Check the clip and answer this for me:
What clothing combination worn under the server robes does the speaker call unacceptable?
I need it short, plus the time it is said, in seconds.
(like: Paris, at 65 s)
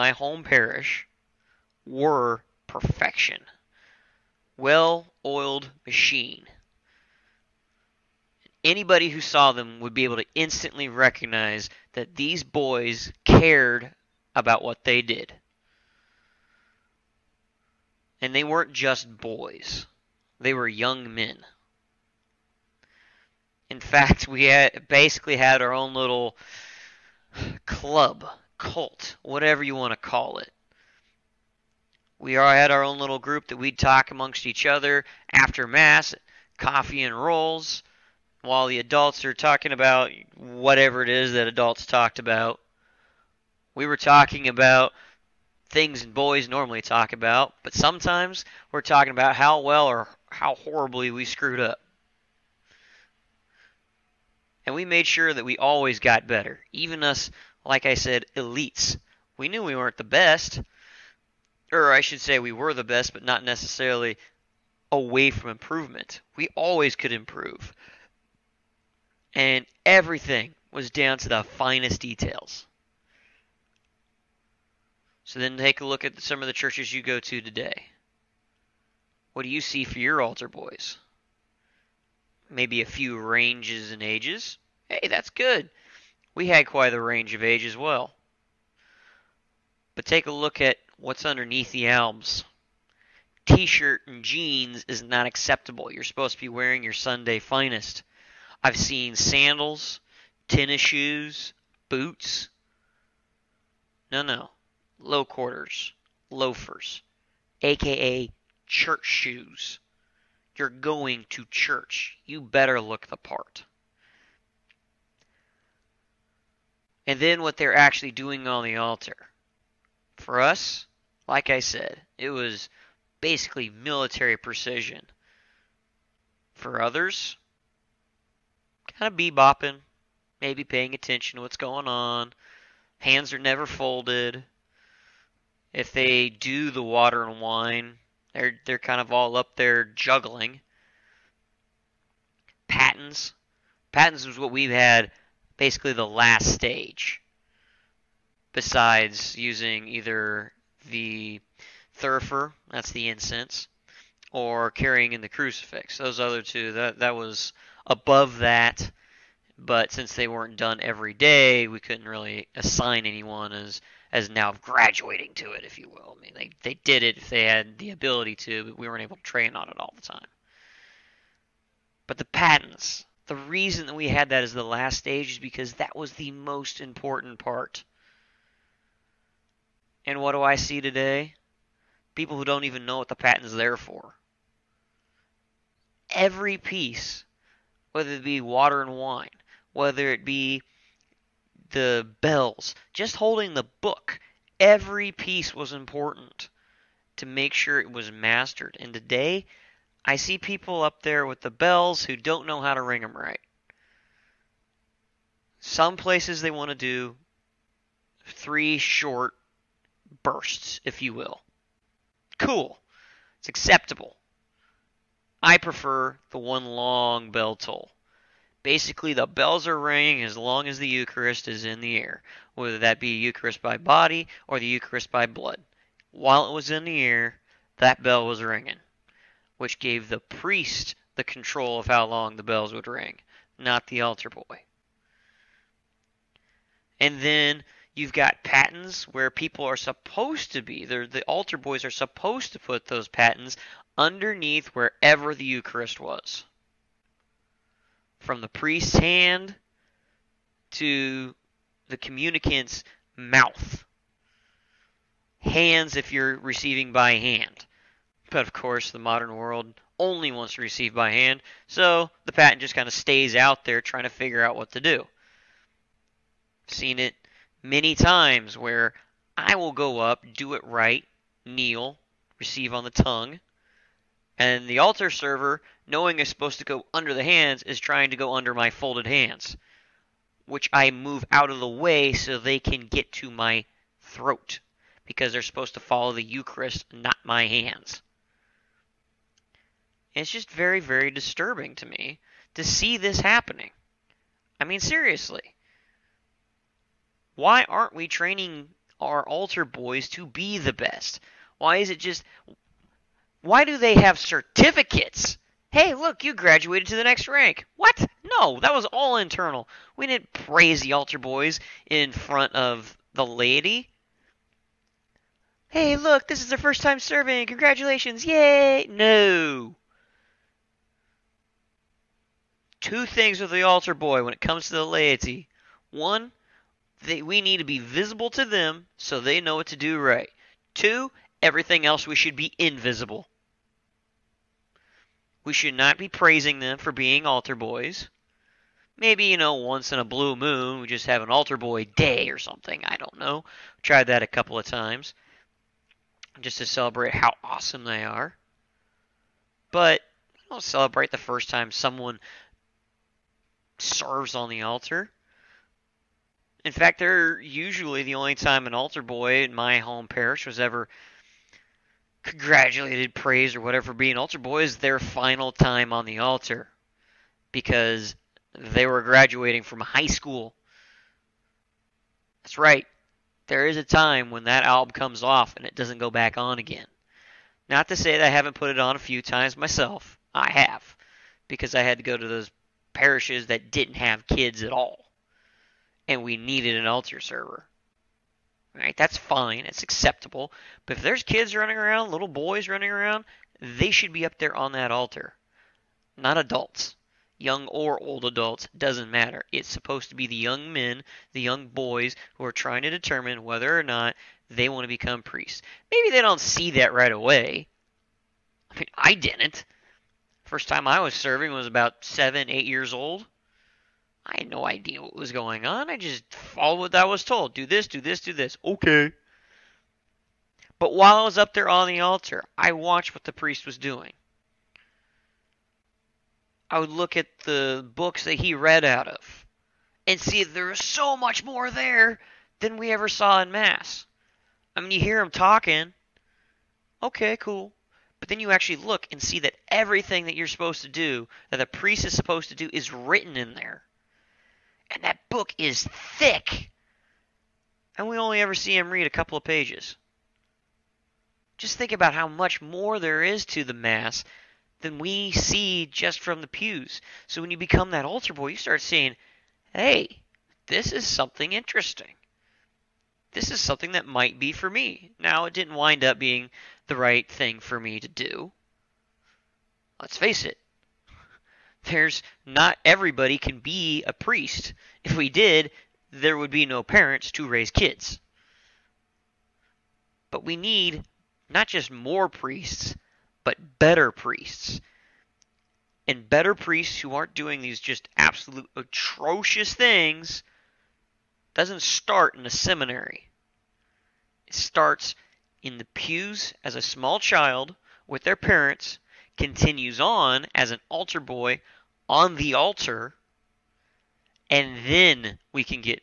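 T shirt and jeans, at 93 s.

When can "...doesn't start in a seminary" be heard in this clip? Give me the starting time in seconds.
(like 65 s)
491 s.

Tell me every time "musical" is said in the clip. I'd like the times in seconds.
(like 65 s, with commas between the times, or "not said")
not said.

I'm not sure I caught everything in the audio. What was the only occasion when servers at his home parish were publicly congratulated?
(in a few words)
Graduating from high school.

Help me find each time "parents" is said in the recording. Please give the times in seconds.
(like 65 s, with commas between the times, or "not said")
476 s, 498 s.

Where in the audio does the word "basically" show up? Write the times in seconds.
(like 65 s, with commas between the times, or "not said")
24 s, 123 s, 145 s, 218 s.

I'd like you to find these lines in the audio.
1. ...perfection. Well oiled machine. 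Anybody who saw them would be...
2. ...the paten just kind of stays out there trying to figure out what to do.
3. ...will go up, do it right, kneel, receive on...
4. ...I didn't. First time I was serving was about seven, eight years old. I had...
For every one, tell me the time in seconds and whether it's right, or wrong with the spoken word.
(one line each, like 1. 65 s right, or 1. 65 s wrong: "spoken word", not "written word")
1. 2 s right
2. 262 s right
3. 269 s right
4. 408 s right.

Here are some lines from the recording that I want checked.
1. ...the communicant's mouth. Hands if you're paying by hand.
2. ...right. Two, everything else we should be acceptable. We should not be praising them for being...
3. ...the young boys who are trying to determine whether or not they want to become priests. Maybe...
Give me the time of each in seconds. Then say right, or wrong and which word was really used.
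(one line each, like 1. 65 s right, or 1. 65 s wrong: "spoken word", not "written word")
1. 251 s wrong: "receiving", not "paying"
2. 329 s wrong: "invisible", not "acceptable"
3. 401 s right.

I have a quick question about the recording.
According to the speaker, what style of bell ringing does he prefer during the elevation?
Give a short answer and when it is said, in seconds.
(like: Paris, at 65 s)
One long bell toll, at 216 s.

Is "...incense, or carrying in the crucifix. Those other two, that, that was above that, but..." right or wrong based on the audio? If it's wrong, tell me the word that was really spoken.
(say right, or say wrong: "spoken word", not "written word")
right.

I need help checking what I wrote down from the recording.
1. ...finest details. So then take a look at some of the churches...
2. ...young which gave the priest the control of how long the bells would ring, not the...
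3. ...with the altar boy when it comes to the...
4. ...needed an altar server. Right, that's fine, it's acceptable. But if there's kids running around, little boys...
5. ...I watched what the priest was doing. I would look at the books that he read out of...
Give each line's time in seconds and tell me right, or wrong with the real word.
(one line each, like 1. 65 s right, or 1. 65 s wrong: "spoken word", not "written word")
1. 71 s right
2. 228 s wrong: "ringing", not "young"
3. 323 s right
4. 386 s right
5. 422 s right.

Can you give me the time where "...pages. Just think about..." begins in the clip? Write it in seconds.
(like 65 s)
449 s.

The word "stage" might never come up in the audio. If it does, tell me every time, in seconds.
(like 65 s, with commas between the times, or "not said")
146 s, 174 s.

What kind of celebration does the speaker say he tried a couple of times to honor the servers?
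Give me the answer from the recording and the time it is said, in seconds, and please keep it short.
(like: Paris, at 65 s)
Altar boy day, at 341 s.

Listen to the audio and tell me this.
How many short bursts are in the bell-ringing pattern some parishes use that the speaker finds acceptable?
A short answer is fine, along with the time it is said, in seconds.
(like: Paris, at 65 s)
3, at 208 s.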